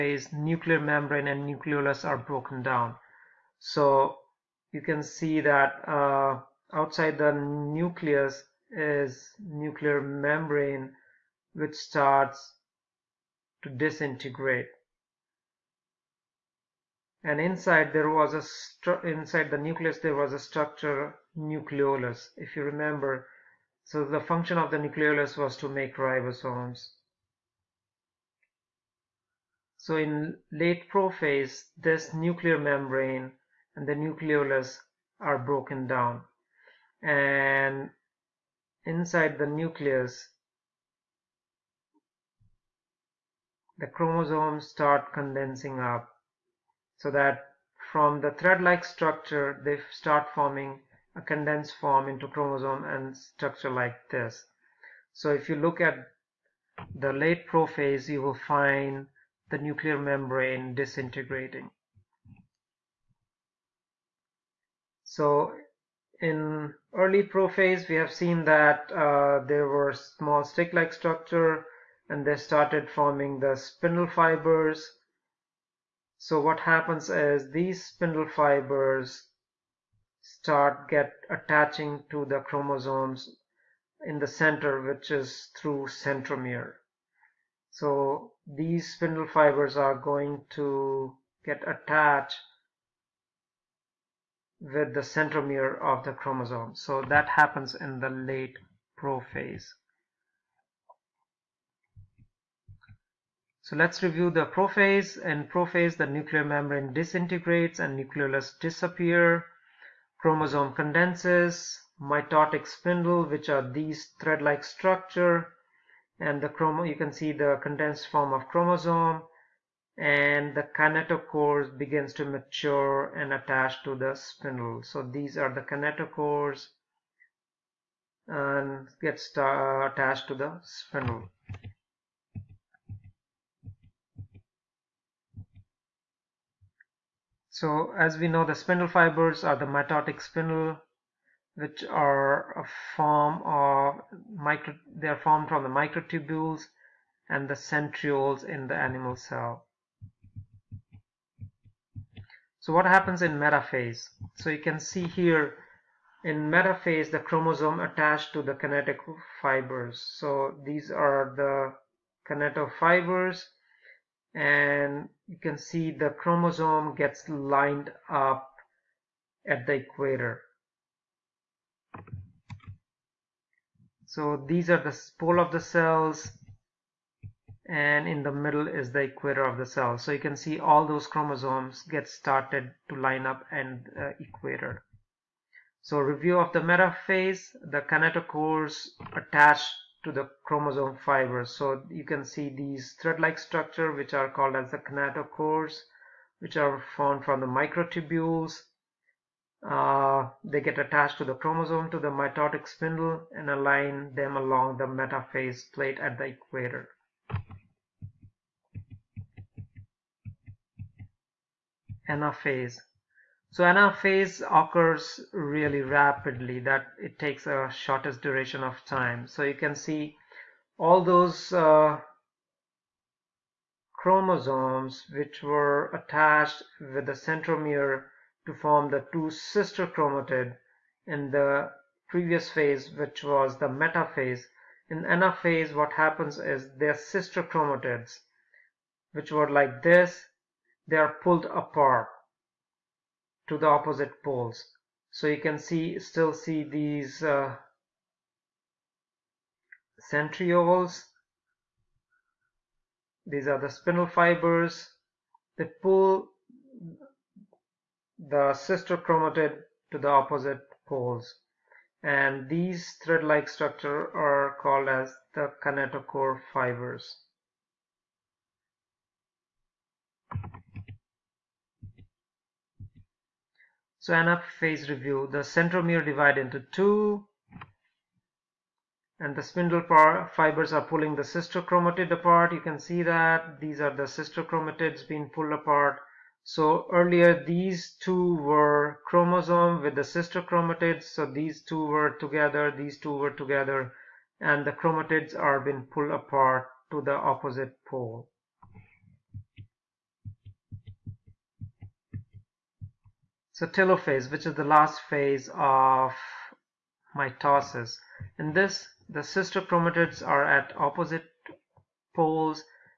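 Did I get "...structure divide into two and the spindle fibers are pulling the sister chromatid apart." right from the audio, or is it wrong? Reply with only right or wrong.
wrong.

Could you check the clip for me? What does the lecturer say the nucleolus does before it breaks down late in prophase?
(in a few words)
to make ribosomes.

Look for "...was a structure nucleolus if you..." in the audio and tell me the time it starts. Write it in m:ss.
0:20.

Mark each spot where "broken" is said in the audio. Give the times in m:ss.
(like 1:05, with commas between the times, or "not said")
0:02, 0:35.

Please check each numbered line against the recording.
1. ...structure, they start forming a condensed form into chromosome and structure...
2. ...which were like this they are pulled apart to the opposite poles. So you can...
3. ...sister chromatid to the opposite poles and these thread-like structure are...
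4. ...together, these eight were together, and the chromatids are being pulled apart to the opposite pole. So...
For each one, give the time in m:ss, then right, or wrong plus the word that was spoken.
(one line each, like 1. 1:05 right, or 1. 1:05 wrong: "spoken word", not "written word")
1. 0:48 right
2. 3:59 right
3. 4:18 right
4. 4:52 wrong: "two", not "eight".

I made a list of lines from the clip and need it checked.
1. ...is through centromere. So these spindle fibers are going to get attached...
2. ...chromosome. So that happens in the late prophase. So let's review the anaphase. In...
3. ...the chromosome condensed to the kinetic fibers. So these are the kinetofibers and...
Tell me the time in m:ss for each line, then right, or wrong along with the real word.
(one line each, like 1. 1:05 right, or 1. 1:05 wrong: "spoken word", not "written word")
1. 1:25 right
2. 1:36 wrong: "prophase", not "anaphase"
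3. 2:37 wrong: "attached", not "condensed".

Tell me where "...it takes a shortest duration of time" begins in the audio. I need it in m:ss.
3:36.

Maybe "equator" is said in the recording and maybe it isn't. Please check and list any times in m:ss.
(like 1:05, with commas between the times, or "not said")
2:49, 2:59, 3:04, 3:26.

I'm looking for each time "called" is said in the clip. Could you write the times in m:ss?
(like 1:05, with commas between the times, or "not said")
3:14, 4:24.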